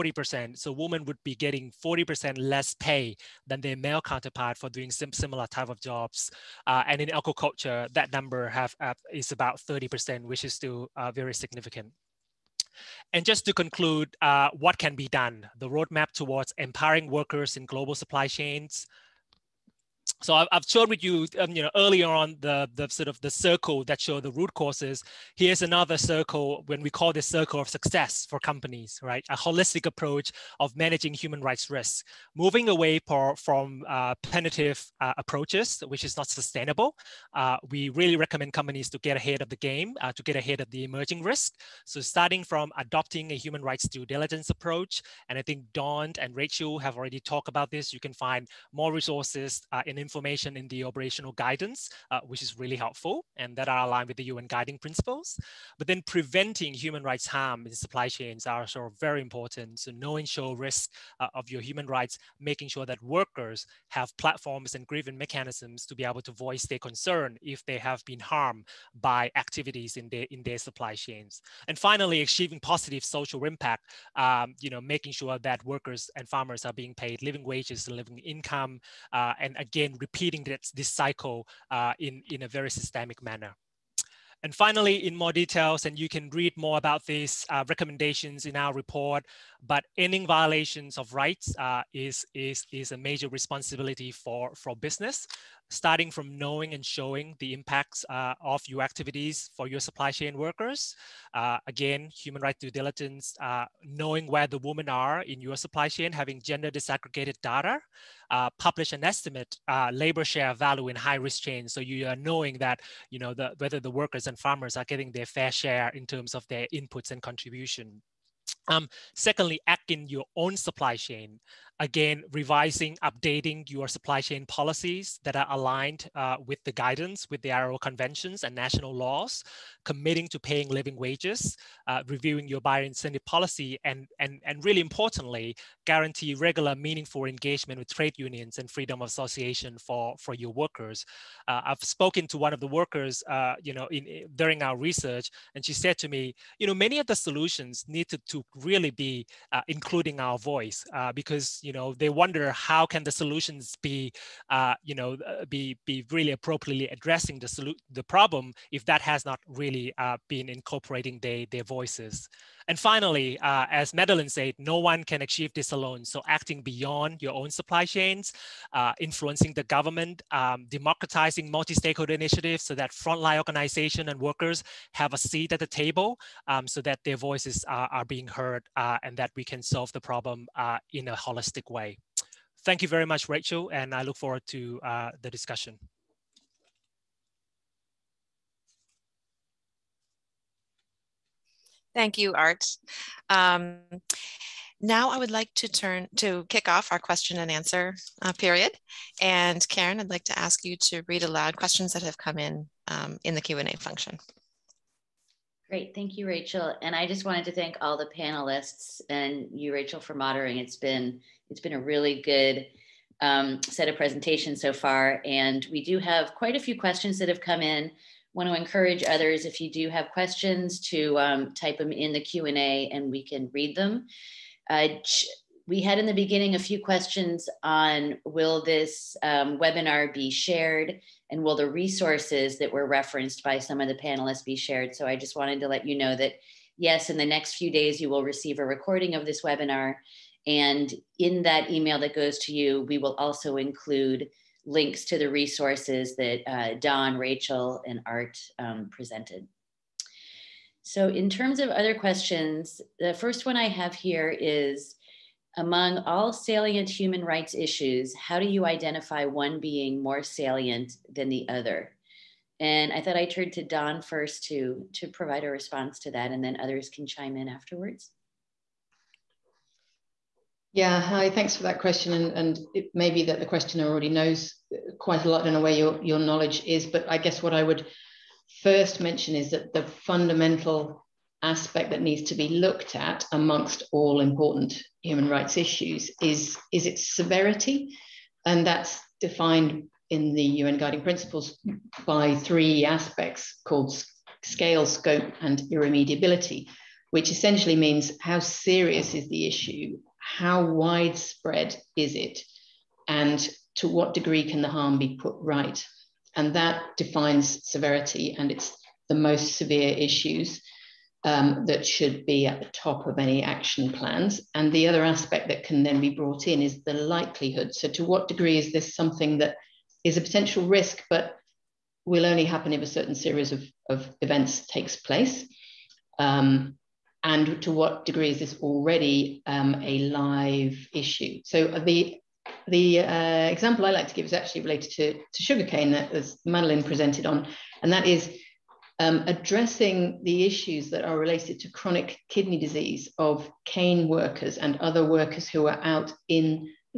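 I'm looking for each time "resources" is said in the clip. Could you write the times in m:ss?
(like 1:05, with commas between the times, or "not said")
0:48, 3:51, 4:05.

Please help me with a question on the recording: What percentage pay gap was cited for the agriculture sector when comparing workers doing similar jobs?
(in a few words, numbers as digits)
30%.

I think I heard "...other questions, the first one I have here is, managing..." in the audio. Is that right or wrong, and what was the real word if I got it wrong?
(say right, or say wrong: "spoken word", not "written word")
wrong: "among", not "managing".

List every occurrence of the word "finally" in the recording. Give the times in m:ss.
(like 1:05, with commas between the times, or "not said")
1:11, 1:24, 2:42.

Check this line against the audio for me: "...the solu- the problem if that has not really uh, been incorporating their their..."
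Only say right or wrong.
right.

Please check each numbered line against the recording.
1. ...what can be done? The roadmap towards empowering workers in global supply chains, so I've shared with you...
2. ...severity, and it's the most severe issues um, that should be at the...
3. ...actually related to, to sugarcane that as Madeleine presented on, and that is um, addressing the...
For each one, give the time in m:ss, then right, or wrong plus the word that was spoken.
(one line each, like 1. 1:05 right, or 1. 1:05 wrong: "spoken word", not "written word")
1. 0:14 right
2. 5:07 right
3. 5:34 right.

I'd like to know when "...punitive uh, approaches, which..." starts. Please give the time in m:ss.
0:34.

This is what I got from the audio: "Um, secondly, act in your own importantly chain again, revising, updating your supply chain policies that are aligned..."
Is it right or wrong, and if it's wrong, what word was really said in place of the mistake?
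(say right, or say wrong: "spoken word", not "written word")
wrong: "supply", not "importantly".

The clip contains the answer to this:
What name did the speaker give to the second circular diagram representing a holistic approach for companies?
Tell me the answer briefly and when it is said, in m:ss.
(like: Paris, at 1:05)
circle of success, at 0:27.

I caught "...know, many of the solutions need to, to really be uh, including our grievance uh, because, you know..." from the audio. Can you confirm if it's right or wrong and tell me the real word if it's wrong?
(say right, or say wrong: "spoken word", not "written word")
wrong: "voice", not "grievance".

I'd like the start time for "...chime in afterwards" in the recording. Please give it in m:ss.
4:27.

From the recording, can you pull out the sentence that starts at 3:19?
And Karen, I'd like to ask you to read aloud questions that have come in um, in the Q&A function.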